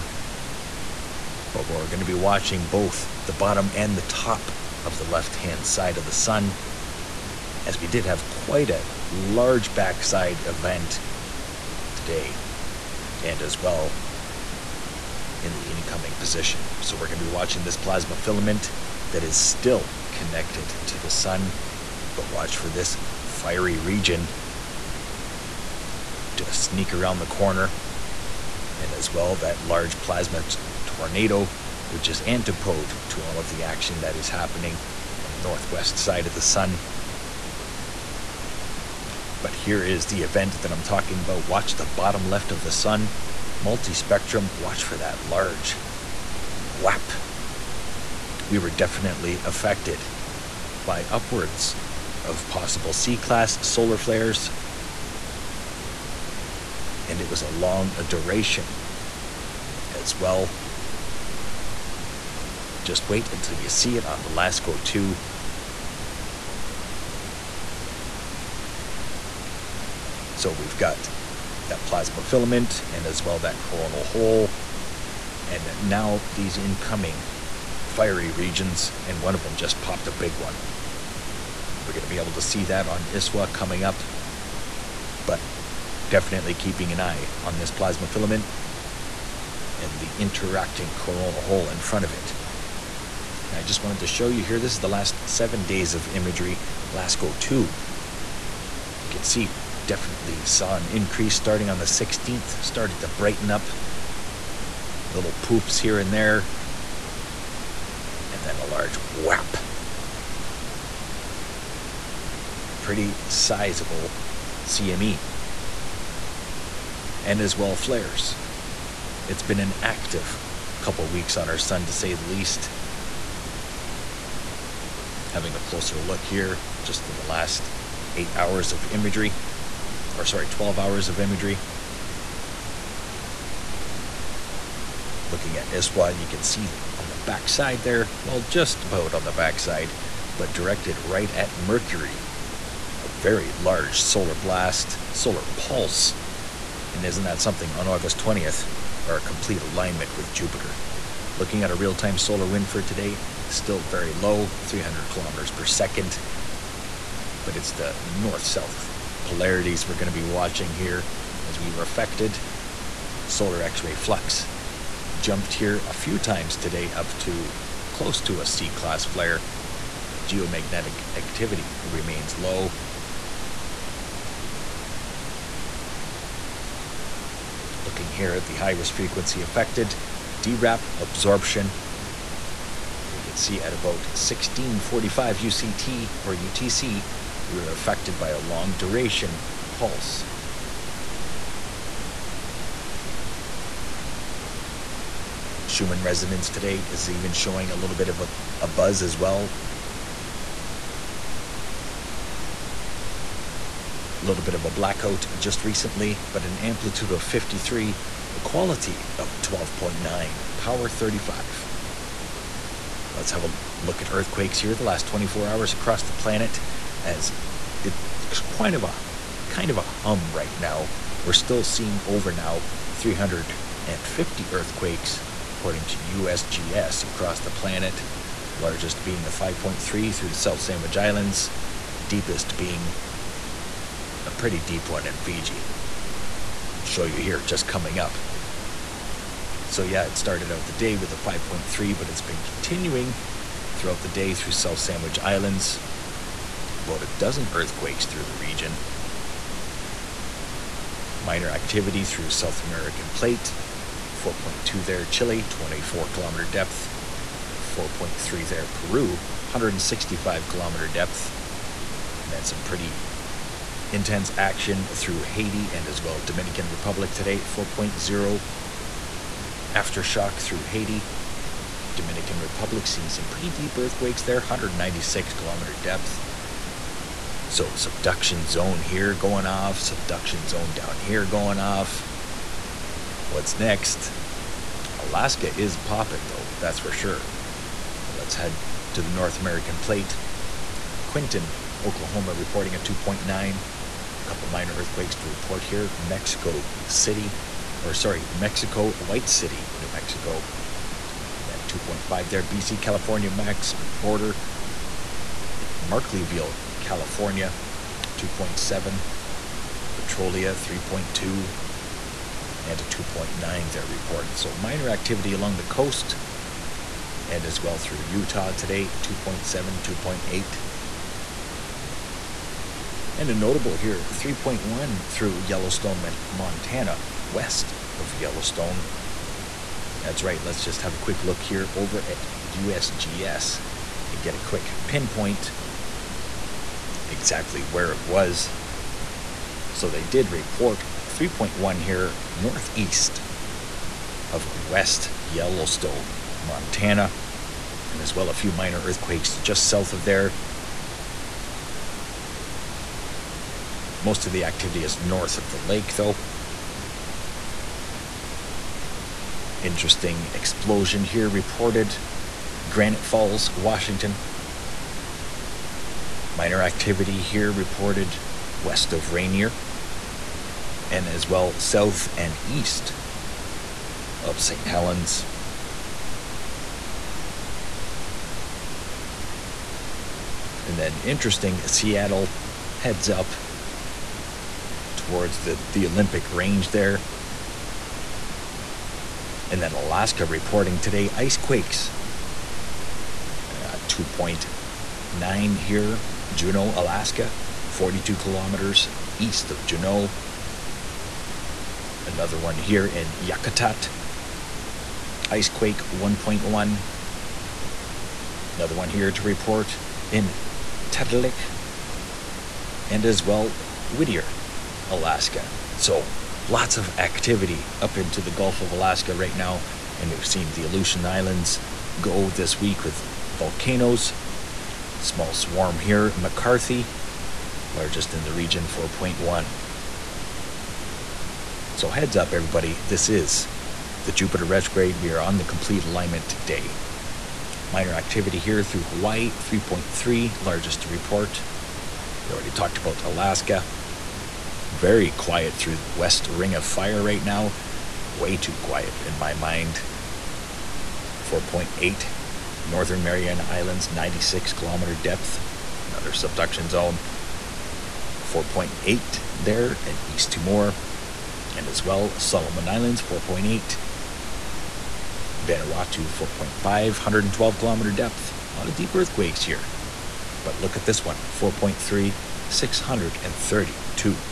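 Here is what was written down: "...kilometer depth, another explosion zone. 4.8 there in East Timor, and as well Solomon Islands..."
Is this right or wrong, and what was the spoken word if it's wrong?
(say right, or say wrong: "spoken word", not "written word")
wrong: "subduction", not "explosion".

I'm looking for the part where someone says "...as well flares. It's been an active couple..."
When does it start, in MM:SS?
01:57.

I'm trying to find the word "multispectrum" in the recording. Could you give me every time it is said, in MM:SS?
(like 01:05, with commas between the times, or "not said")
00:43.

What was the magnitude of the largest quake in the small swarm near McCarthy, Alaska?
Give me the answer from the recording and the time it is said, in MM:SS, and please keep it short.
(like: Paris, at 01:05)
4.1, at 07:08.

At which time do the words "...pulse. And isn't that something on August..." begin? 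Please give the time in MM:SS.
02:25.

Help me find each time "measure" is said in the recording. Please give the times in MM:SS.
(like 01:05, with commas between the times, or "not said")
not said.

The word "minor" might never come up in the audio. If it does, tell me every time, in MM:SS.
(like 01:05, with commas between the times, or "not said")
04:11, 04:54, 05:14, 05:48, 06:06, 07:17.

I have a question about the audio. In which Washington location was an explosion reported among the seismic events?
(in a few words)
Granite Falls.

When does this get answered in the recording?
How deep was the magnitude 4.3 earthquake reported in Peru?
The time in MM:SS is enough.
04:19.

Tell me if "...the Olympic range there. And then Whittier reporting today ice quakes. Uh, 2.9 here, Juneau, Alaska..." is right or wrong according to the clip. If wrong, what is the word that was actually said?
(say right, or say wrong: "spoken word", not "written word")
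wrong: "Alaska", not "Whittier".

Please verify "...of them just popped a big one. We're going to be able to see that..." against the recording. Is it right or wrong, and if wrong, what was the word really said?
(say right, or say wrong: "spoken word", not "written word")
right.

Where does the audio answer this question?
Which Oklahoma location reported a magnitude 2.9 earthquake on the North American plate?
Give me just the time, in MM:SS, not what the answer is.
04:51.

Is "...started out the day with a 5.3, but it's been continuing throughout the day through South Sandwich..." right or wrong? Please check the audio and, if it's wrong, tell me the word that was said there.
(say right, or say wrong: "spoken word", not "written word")
right.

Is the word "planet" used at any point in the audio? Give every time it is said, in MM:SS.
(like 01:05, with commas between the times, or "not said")
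03:36, 03:47.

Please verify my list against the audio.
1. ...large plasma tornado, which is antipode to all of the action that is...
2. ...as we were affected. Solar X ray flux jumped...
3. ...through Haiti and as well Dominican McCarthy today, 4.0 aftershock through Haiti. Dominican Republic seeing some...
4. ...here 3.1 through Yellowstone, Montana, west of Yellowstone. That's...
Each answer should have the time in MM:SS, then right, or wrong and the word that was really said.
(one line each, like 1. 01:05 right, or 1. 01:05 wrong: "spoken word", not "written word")
1. 00:29 right
2. 02:41 right
3. 04:24 wrong: "Republic", not "McCarthy"
4. 05:23 right.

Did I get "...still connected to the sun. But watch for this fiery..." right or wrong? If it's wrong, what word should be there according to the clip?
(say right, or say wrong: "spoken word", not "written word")
right.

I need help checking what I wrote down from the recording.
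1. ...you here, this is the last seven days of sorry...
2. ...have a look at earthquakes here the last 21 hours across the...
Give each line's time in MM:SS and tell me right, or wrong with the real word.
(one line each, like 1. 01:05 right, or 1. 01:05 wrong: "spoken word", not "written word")
1. 01:34 wrong: "imagery", not "sorry"
2. 03:33 wrong: "24", not "21".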